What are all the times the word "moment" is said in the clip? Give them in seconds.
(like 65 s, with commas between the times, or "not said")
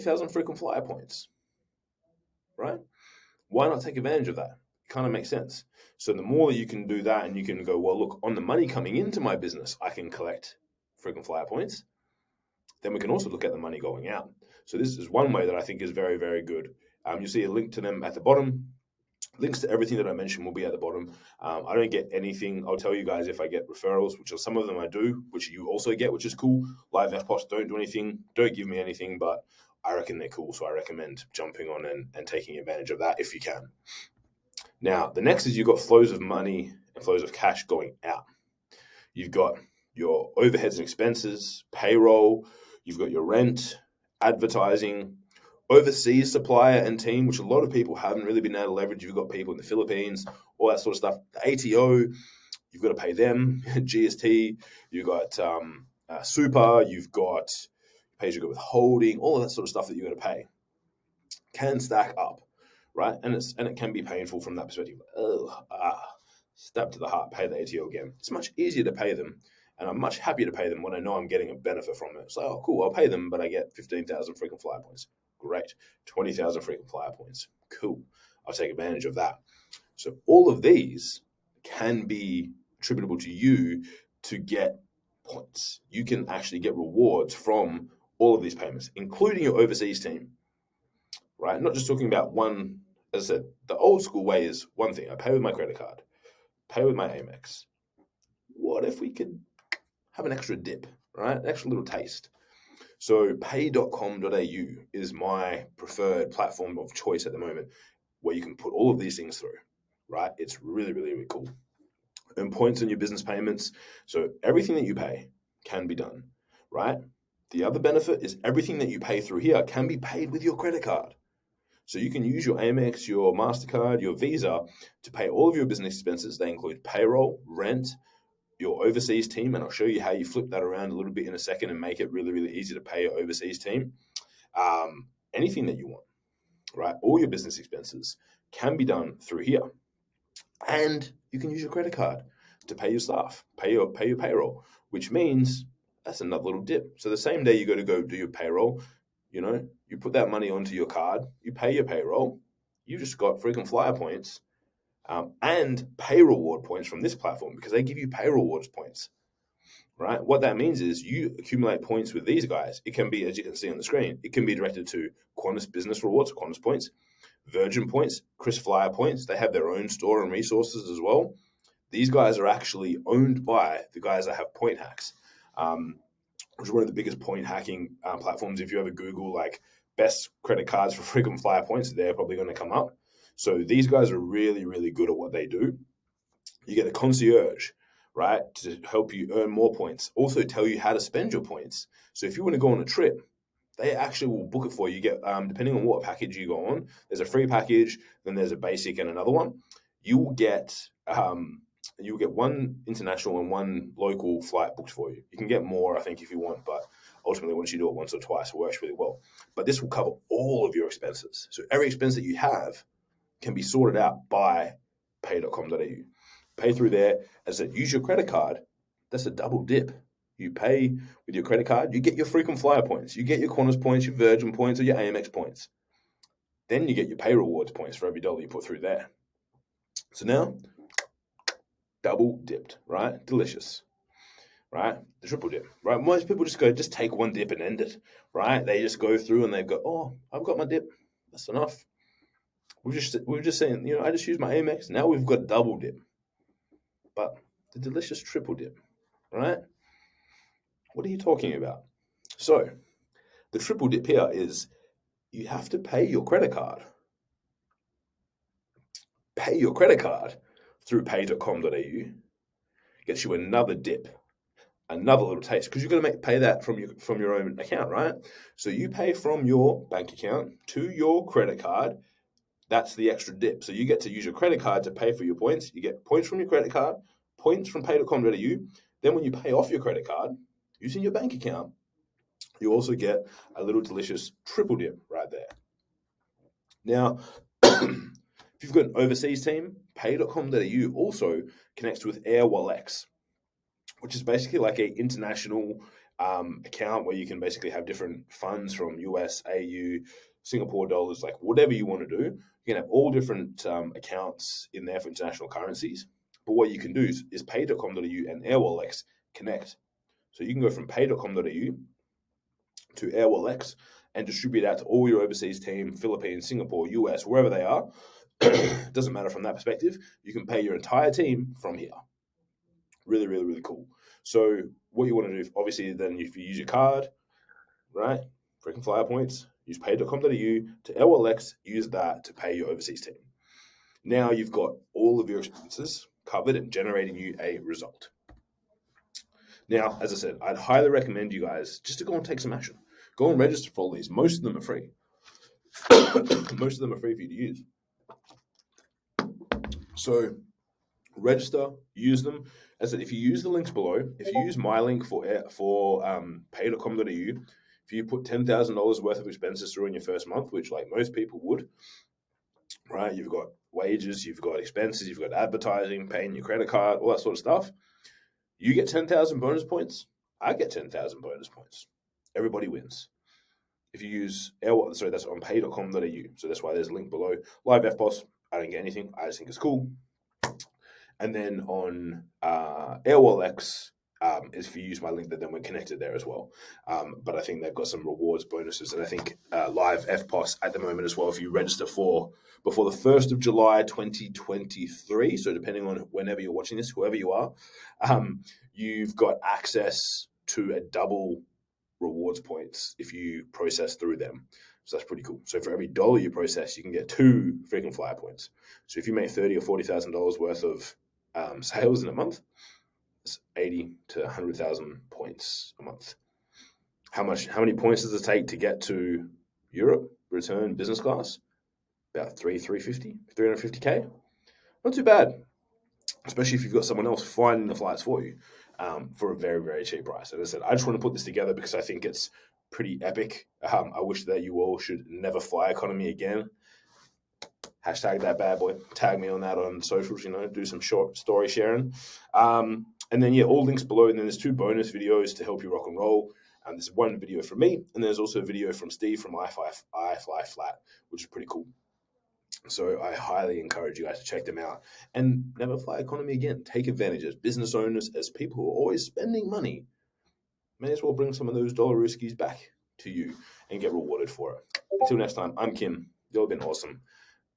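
107 s, 390 s.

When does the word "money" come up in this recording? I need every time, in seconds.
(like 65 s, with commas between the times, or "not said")
8 s, 13 s, 36 s, 150 s, 459 s.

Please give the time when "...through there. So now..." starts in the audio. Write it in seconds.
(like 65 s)
228 s.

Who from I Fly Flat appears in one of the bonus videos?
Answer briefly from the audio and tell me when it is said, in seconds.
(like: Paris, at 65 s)
Steve, at 448 s.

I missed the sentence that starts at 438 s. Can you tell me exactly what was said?
Tag me on that on socials, you know, do some short story sharing.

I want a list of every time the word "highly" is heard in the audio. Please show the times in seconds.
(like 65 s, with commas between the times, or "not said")
340 s, 453 s.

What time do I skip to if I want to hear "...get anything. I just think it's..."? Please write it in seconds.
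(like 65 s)
378 s.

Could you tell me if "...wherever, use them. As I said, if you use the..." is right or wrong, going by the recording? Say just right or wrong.
wrong.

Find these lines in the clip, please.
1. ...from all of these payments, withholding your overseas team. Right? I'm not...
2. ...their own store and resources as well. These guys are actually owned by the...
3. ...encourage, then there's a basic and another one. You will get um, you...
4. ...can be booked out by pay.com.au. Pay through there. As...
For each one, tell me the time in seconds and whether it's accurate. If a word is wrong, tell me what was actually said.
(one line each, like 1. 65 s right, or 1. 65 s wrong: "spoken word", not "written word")
1. 87 s wrong: "including", not "withholding"
2. 169 s right
3. 197 s wrong: "package", not "encourage"
4. 213 s wrong: "sorted", not "booked".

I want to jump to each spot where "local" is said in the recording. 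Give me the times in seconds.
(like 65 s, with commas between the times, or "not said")
203 s.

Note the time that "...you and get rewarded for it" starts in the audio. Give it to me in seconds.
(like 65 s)
463 s.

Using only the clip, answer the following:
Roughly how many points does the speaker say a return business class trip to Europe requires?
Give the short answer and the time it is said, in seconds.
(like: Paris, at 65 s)
350,000, at 423 s.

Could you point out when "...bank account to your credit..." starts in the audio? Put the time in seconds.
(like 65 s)
269 s.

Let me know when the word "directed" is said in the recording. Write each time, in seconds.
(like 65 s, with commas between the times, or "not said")
164 s.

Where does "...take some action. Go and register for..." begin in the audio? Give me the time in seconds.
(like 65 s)
342 s.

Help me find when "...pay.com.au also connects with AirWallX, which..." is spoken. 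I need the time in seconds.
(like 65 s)
289 s.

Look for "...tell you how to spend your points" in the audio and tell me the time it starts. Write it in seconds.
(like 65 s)
190 s.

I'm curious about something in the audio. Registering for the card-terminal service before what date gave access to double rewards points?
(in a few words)
1 July 2023.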